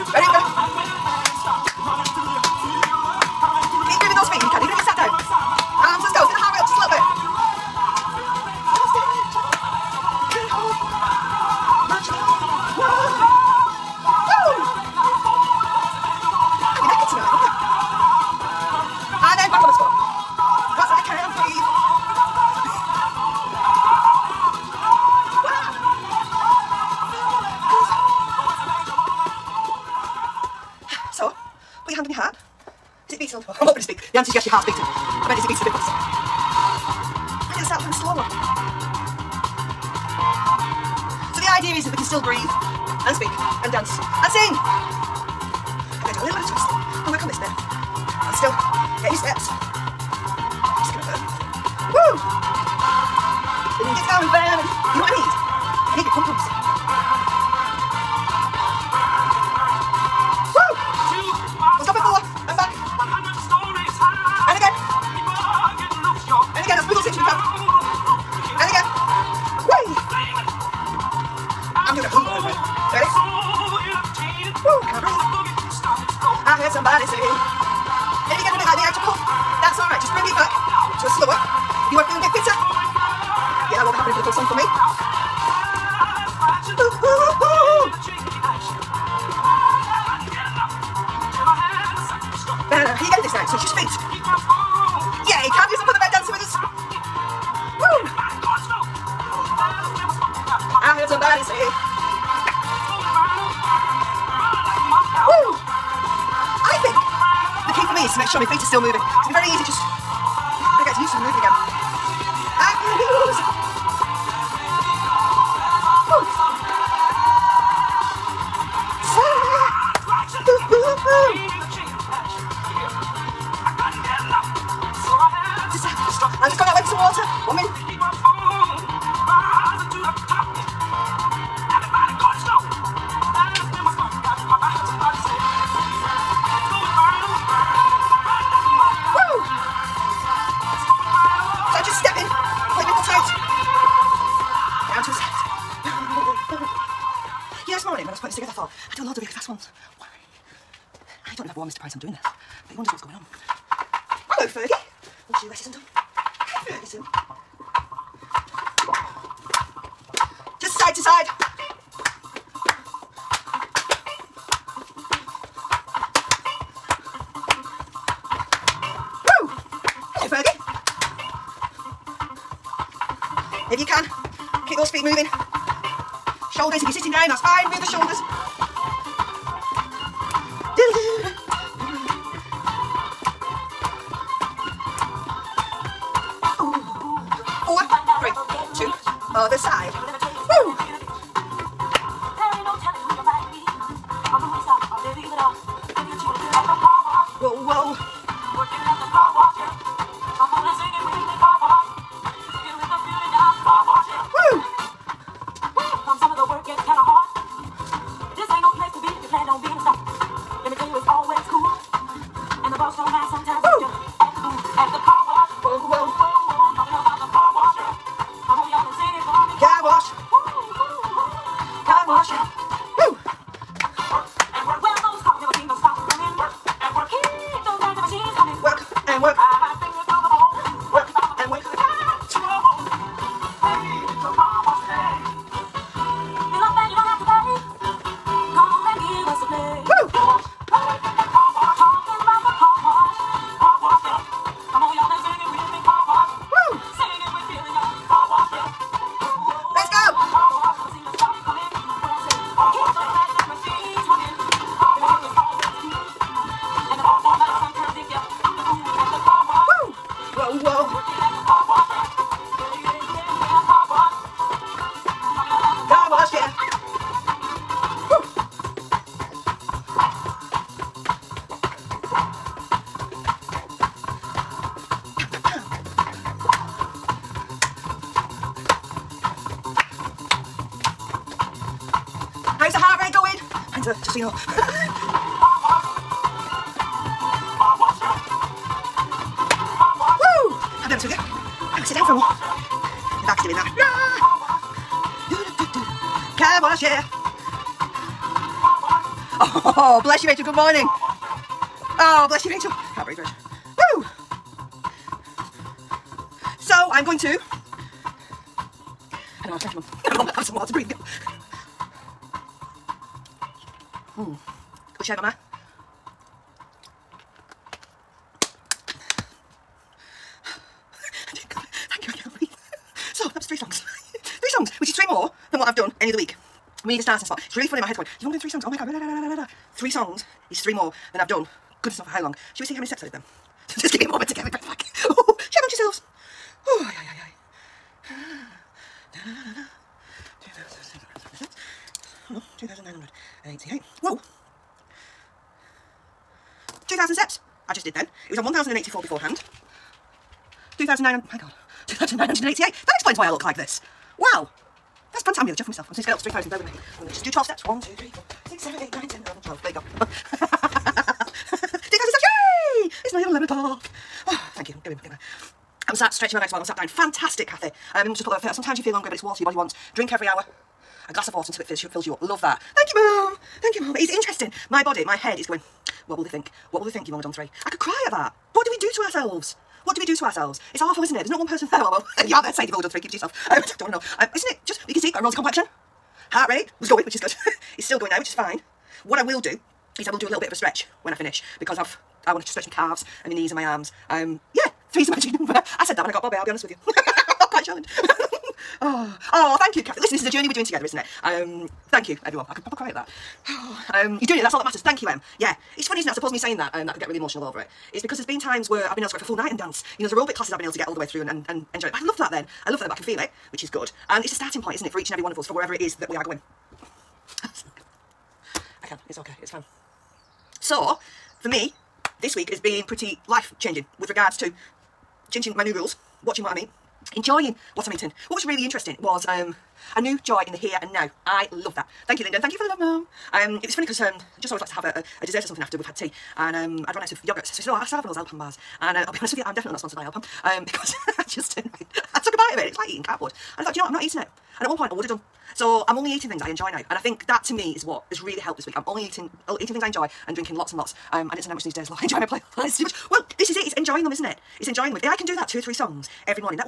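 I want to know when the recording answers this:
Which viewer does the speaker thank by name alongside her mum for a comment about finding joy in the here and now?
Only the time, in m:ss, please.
7:12.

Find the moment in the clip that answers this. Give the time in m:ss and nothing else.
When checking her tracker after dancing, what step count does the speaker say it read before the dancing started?
5:48.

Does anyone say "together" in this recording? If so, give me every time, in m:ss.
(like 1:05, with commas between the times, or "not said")
6:40.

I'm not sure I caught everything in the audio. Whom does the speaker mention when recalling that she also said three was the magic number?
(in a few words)
Bobby.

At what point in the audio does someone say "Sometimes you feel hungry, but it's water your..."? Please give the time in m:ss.
6:08.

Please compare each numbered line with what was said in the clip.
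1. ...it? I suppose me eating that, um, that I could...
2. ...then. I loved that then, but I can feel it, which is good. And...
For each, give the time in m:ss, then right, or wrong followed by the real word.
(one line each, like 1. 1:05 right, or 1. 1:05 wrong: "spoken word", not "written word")
1. 6:46 wrong: "saying", not "eating"
2. 6:52 right.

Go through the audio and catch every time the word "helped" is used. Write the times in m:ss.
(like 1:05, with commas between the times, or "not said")
7:28.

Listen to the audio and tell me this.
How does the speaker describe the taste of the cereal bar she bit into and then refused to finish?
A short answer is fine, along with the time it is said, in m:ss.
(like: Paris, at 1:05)
like eating cardboard, at 7:23.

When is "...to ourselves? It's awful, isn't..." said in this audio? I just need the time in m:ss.
6:20.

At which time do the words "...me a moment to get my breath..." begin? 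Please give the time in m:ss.
5:33.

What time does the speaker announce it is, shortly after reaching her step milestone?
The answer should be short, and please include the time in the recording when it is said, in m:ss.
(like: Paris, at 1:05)
11 o'clock, at 6:03.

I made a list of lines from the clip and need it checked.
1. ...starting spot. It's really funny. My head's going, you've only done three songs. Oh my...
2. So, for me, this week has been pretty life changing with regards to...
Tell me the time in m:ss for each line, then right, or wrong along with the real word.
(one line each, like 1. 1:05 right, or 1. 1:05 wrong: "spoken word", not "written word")
1. 5:27 right
2. 7:00 right.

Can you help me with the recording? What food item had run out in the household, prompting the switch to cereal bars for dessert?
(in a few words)
yogurts.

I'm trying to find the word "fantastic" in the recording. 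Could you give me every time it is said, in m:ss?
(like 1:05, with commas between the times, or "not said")
5:55, 6:06.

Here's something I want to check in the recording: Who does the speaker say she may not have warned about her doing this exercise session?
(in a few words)
Mr. Price.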